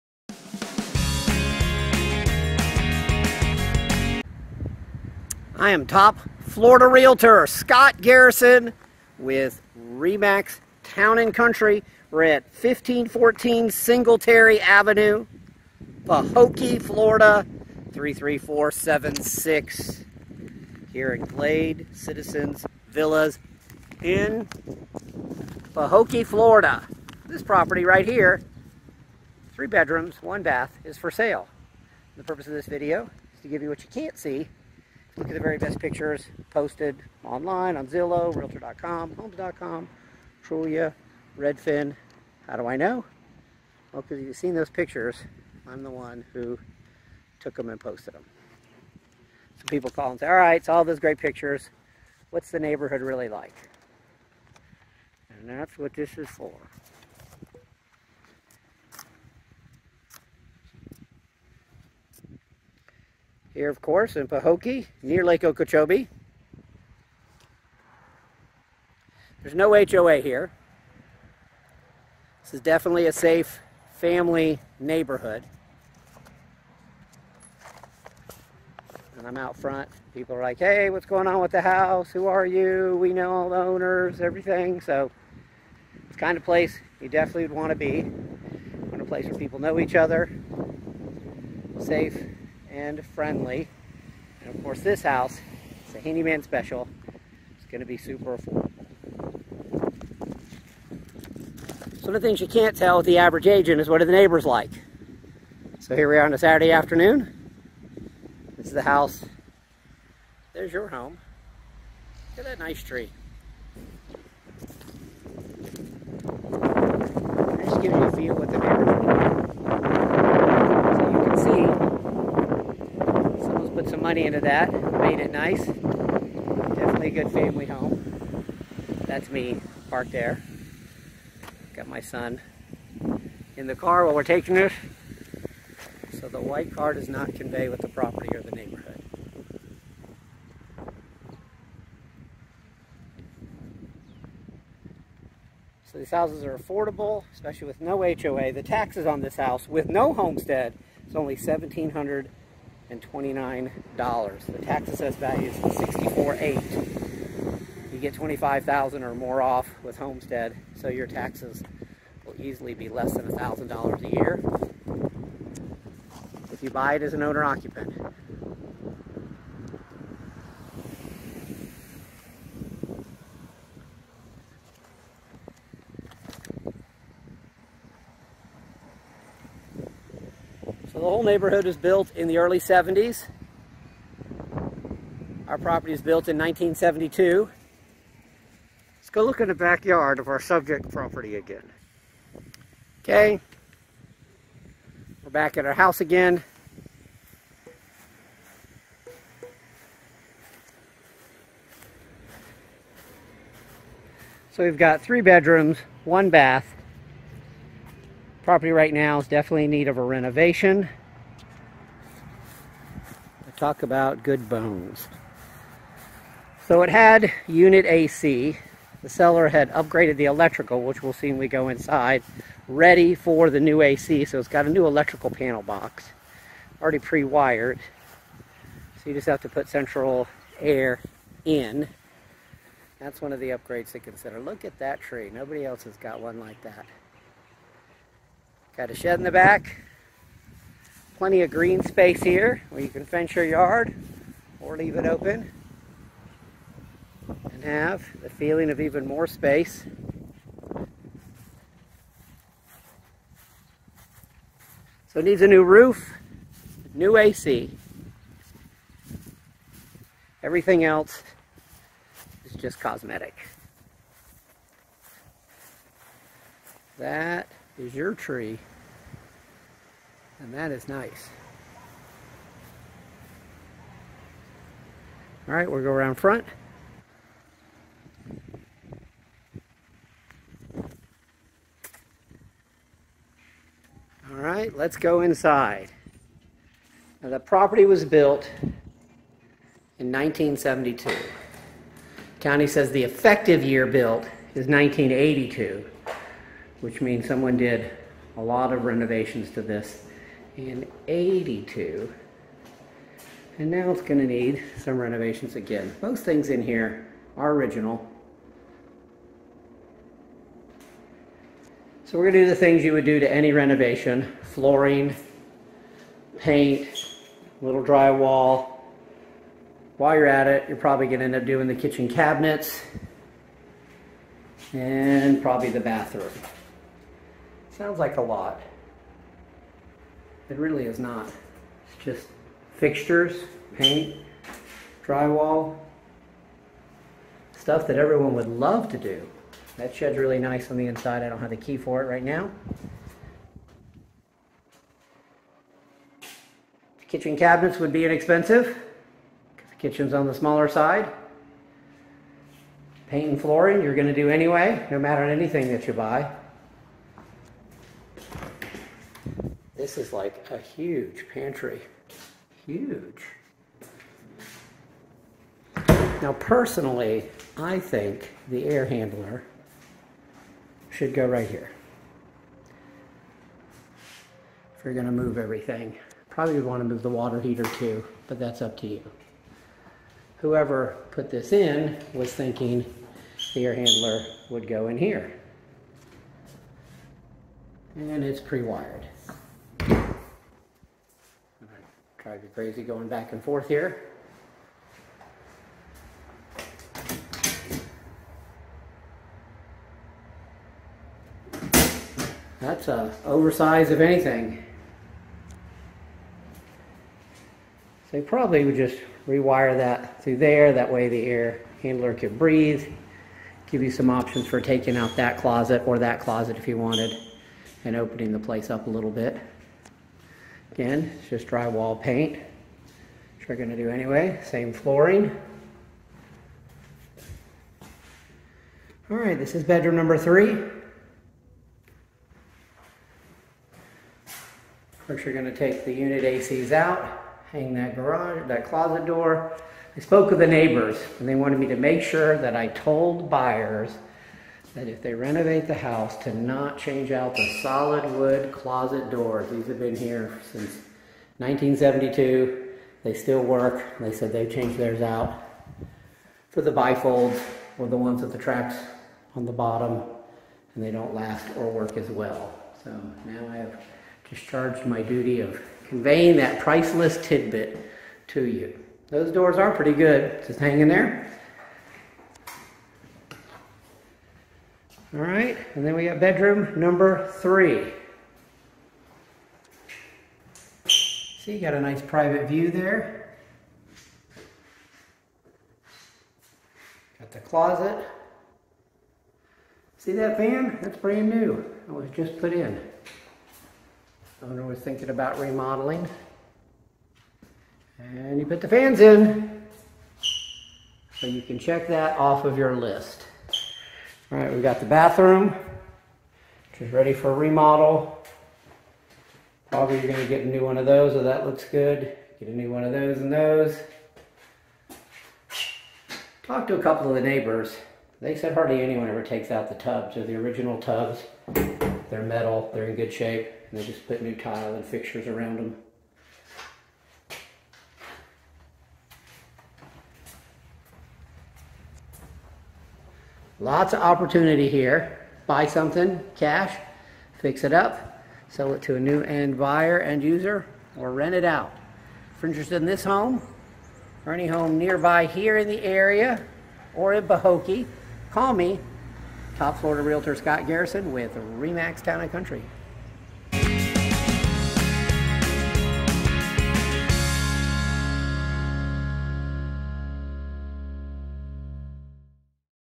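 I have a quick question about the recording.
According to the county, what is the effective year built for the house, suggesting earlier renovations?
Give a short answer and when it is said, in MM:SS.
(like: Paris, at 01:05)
1982, at 04:54.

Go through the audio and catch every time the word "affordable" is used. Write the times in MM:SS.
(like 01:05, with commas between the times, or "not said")
01:38, 02:26.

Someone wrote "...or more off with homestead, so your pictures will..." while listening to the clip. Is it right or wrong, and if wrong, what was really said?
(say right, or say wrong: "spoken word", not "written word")
wrong: "taxes", not "pictures".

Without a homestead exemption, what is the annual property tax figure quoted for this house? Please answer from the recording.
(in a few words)
$1,729.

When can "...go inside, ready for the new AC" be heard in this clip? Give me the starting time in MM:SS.
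03:41.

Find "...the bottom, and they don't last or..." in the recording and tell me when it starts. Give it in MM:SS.
07:39.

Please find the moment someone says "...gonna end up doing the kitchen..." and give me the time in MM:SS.
05:21.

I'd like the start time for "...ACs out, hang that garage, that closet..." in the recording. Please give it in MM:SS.
07:16.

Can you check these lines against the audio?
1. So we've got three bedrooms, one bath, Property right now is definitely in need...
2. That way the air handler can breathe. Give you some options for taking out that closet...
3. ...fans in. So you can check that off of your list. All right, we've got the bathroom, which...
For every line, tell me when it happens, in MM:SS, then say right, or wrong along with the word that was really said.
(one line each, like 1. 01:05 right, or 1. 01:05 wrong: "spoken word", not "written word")
1. 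03:24 right
2. 06:50 right
3. 08:18 right.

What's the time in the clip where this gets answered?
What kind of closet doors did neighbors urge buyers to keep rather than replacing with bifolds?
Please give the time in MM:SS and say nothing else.
07:27.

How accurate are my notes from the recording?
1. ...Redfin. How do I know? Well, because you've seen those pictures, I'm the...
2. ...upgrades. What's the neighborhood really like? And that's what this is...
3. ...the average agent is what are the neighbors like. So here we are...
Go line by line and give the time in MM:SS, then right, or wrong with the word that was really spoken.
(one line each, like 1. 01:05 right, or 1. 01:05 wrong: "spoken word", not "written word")
1. 00:41 right
2. 00:51 wrong: "pictures", not "upgrades"
3. 01:43 right.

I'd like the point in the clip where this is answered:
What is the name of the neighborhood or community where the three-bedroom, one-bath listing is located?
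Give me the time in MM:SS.
00:21.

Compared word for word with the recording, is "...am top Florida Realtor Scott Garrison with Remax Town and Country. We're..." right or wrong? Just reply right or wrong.
right.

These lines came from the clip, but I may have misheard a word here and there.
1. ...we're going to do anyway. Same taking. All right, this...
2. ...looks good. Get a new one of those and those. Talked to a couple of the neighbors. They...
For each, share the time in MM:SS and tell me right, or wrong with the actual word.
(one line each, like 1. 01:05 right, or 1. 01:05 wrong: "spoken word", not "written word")
1. 07:03 wrong: "flooring", not "taking"
2. 08:31 right.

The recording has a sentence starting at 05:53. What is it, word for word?
Paint and flooring you're going to do anyway, no matter anything that you buy.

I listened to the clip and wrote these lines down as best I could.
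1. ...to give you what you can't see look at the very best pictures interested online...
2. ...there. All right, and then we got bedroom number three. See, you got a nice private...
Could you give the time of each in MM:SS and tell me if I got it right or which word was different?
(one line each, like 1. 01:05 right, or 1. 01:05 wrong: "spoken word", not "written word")
1. 00:33 wrong: "posted", not "interested"
2. 07:50 right.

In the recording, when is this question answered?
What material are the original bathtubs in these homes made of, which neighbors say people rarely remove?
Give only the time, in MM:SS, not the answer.
08:42.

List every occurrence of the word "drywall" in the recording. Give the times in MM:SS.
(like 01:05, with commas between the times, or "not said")
05:17, 05:35, 07:01.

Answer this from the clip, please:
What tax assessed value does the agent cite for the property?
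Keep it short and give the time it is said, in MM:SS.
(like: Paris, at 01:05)
64,800, at 02:35.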